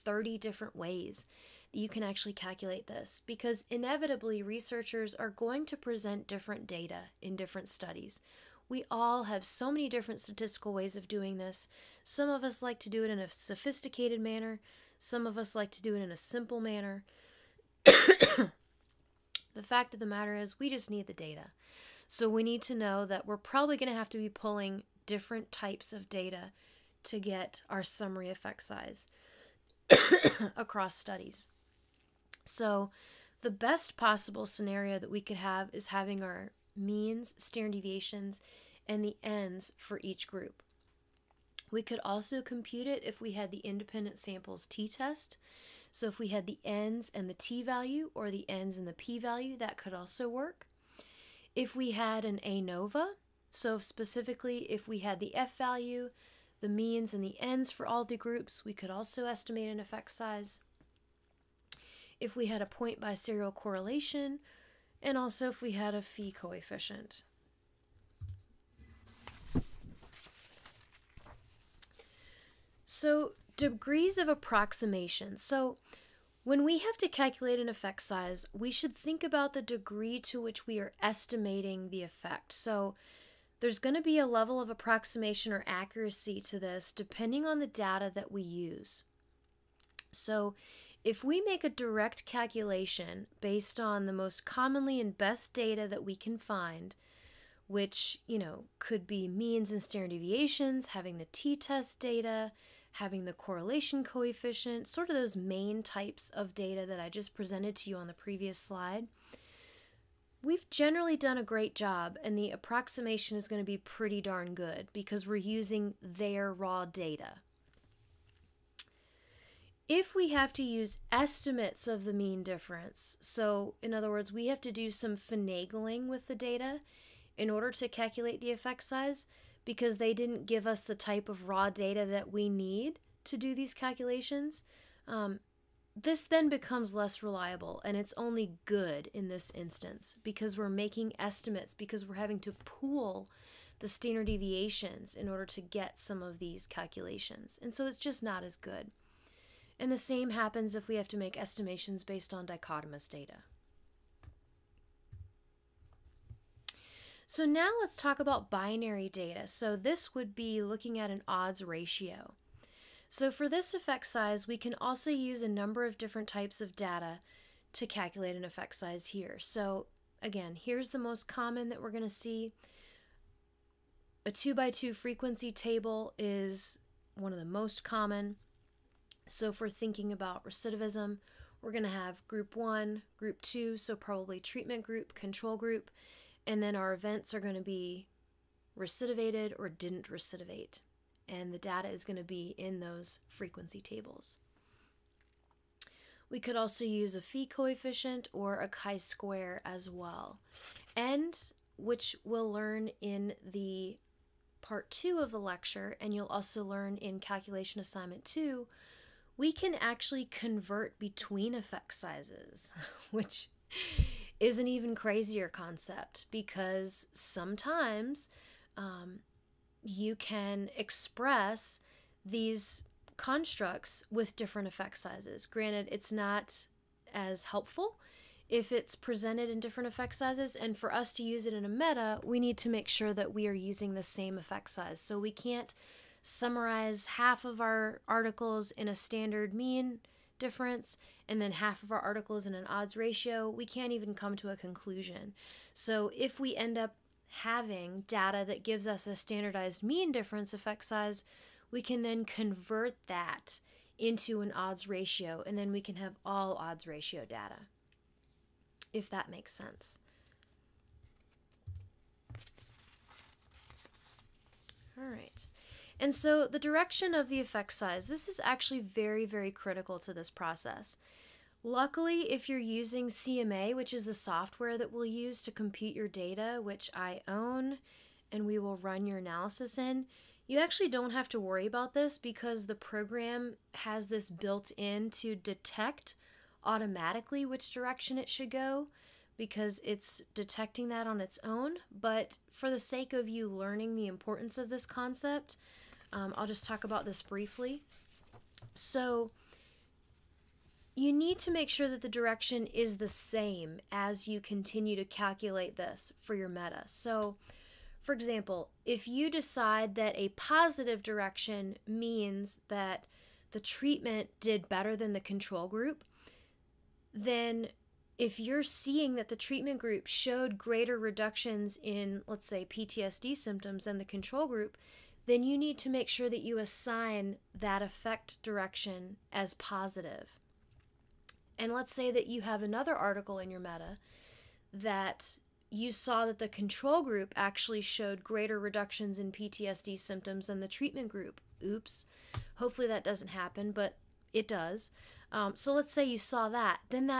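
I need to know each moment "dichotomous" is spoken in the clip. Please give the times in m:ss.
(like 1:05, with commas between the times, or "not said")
2:32.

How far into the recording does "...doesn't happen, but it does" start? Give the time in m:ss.
5:43.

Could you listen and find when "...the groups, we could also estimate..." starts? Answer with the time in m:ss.
0:58.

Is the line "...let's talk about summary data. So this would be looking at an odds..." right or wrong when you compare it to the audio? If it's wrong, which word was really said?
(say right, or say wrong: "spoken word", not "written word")
wrong: "binary", not "summary".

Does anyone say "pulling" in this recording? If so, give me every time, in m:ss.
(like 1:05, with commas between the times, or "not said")
0:24.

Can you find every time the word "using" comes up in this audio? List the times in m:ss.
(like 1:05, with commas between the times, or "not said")
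1:55, 3:53, 4:32.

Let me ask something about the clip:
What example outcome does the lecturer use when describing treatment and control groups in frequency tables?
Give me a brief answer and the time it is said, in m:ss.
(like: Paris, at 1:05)
Recidivism, at 3:00.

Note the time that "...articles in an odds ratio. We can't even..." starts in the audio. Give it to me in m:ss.
4:01.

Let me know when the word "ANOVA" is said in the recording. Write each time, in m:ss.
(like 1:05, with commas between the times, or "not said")
0:52.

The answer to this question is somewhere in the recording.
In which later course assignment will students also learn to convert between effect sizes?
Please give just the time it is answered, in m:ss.
3:27.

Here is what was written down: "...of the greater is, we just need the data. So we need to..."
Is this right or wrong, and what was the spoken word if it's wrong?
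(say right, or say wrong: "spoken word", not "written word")
wrong: "matter", not "greater".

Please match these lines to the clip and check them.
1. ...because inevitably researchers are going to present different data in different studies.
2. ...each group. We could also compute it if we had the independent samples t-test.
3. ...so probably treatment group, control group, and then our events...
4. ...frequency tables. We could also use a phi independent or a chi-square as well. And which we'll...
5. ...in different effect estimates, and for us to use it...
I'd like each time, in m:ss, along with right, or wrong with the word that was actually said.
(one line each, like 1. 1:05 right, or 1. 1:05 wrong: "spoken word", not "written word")
1. 0:03 right
2. 0:40 right
3. 3:03 right
4. 3:13 wrong: "coefficient", not "independent"
5. 3:49 wrong: "sizes", not "estimates".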